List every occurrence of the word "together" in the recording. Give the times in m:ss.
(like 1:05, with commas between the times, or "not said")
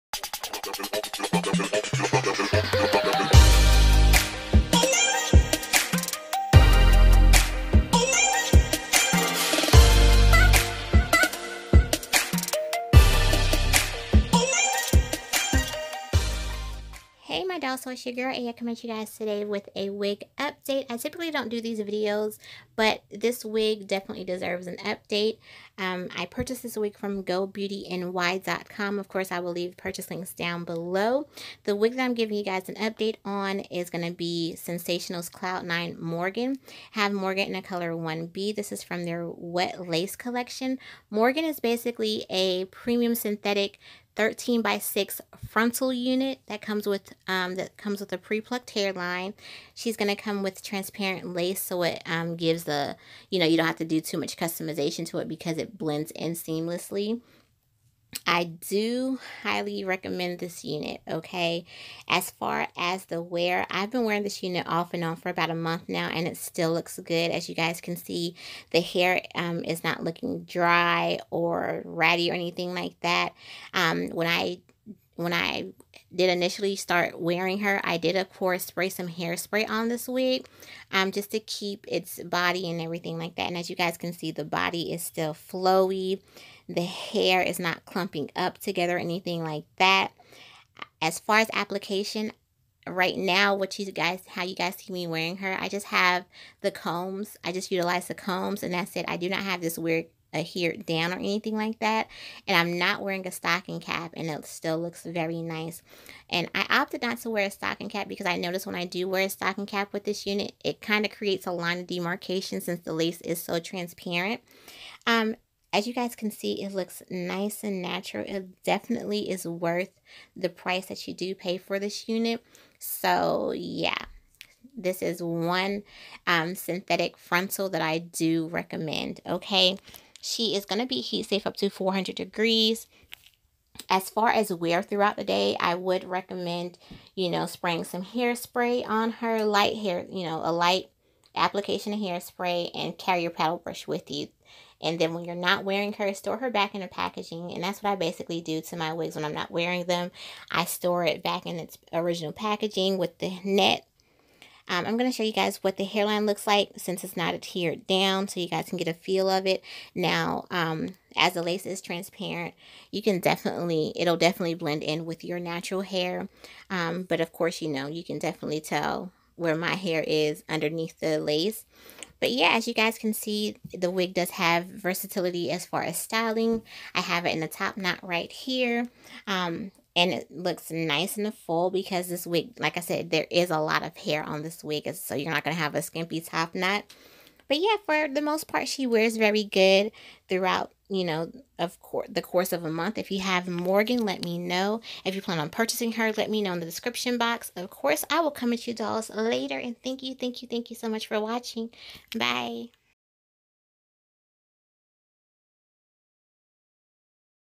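1:28.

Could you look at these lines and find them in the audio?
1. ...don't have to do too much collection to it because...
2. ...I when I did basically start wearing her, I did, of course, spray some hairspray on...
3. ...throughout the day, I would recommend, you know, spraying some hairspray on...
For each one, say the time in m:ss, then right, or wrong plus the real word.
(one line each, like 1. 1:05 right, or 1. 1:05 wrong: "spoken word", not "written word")
1. 0:53 wrong: "customization", not "collection"
2. 1:14 wrong: "initially", not "basically"
3. 2:14 right.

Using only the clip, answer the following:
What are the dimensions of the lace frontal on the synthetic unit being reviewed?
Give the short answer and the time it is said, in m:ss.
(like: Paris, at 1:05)
13 by 6, at 0:44.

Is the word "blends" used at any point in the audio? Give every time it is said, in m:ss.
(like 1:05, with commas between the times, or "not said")
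0:55, 2:44.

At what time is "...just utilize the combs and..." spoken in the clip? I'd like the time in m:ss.
1:37.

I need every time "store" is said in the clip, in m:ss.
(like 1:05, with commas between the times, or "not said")
2:26, 2:30.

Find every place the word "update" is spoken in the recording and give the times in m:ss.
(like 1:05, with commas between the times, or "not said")
0:20, 0:24, 0:32.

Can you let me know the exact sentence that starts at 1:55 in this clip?
Um, as you guys can see, it looks nice and natural.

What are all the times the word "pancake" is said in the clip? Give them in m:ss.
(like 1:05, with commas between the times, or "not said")
not said.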